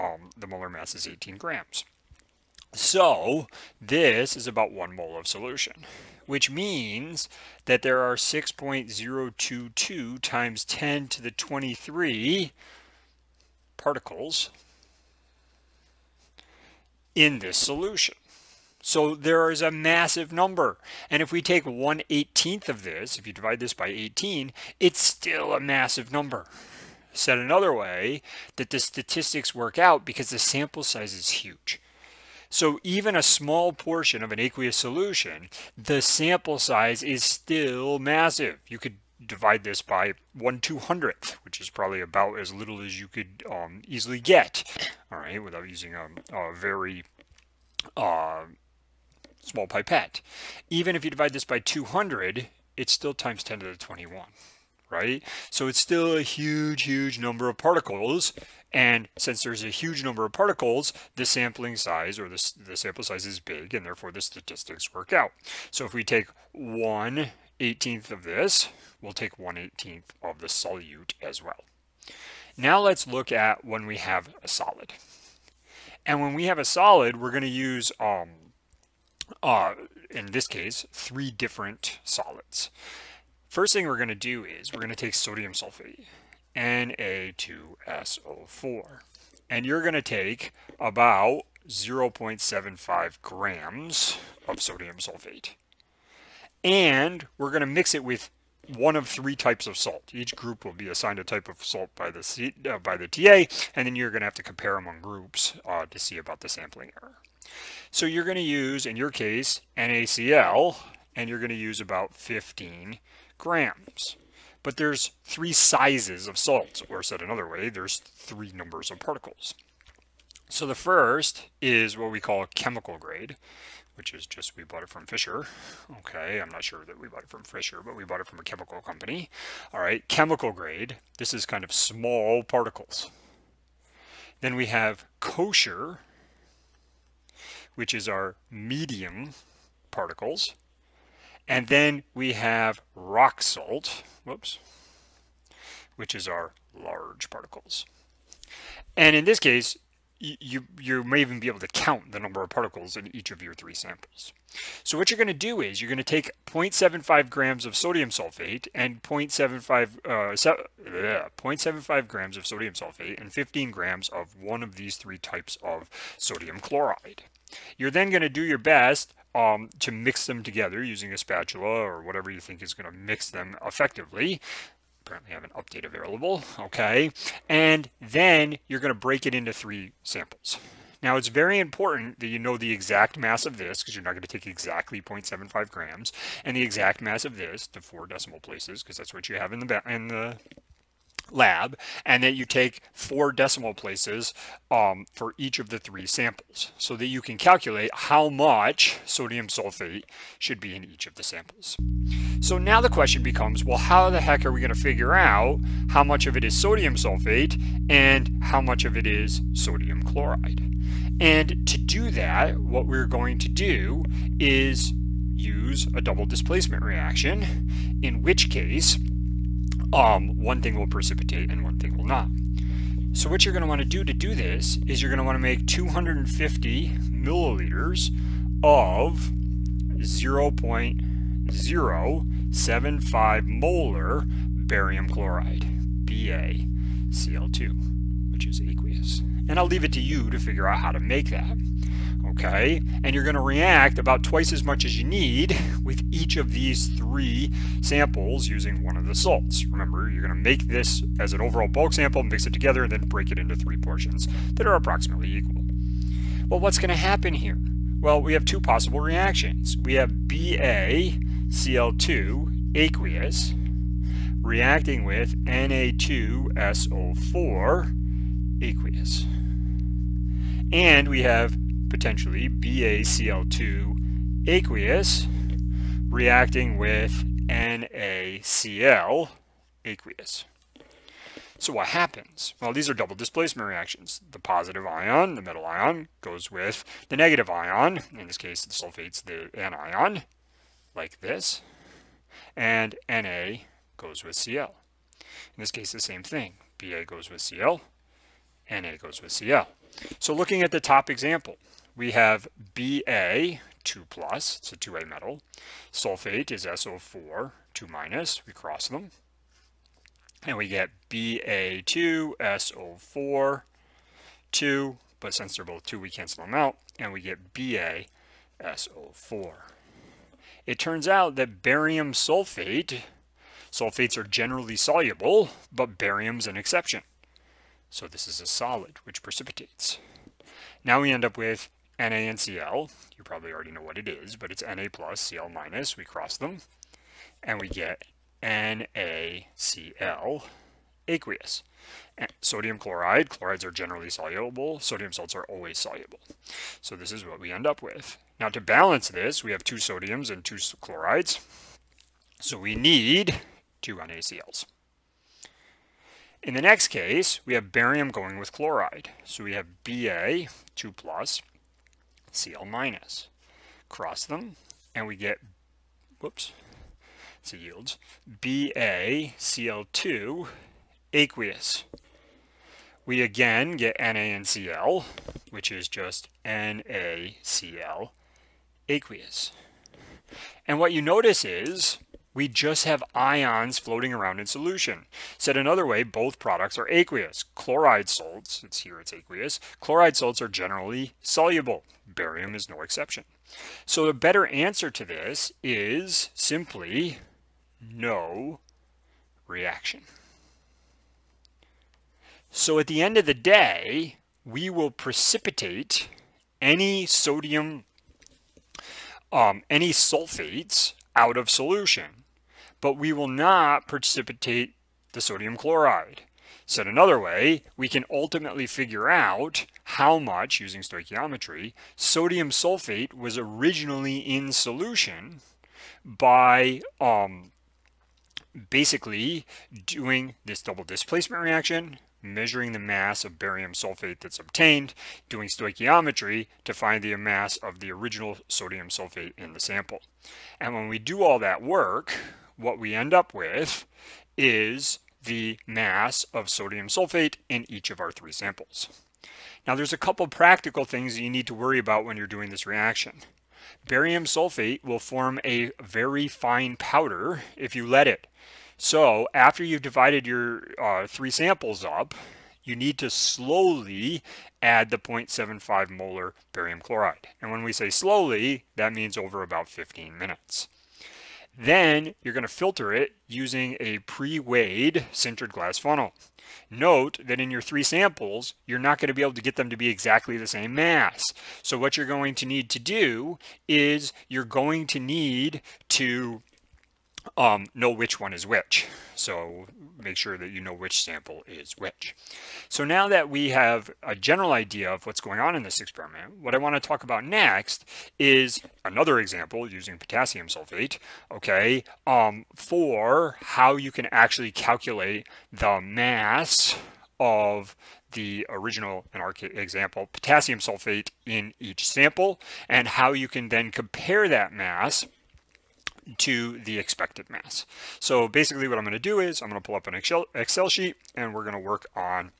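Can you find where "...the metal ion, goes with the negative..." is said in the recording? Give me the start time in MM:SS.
04:45.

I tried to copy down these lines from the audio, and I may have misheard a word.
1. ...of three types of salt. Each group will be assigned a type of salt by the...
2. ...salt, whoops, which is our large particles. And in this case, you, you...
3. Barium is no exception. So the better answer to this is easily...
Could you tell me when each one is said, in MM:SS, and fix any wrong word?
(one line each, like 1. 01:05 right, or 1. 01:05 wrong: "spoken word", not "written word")
1. 01:38 right
2. 02:23 right
3. 06:32 wrong: "simply", not "easily".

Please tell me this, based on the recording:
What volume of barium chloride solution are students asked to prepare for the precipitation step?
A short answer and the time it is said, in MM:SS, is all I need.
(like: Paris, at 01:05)
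250 milliliters, at 03:45.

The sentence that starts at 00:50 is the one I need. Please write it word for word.
Even if you divide this by 200, it's still times 10 to the 21, right?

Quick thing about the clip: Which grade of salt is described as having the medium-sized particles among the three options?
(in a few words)
Kosher.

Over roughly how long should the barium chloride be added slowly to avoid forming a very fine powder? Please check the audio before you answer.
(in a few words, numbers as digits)
15 minutes.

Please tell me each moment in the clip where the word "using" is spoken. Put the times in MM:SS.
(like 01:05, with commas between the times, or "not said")
00:45, 02:50, 04:08, 07:00, 07:53, 08:19.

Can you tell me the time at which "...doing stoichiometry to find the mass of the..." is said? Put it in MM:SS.
07:15.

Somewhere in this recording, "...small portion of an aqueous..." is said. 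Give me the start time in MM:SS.
00:33.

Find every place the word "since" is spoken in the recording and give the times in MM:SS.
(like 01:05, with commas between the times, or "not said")
00:59, 05:15.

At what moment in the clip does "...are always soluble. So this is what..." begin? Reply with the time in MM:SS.
05:45.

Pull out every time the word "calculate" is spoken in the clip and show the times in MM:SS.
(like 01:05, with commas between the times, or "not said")
03:17, 08:24.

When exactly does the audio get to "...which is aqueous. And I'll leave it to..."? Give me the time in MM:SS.
03:58.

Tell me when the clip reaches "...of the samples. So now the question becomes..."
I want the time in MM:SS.
03:21.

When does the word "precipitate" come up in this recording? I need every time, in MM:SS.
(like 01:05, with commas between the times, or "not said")
03:40, 05:29, 06:44, 06:53.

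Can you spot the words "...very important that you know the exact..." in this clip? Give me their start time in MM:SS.
03:01.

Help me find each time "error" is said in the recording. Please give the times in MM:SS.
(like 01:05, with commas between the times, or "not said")
01:47.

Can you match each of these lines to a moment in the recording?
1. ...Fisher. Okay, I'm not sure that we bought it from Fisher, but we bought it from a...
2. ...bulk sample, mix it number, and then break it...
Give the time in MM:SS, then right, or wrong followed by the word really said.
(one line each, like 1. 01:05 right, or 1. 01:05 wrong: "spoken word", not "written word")
1. 02:05 right
2. 04:11 wrong: "together", not "number".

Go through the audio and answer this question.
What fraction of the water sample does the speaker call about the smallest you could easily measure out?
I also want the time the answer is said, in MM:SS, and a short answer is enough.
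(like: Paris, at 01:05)
1/200, at 00:40.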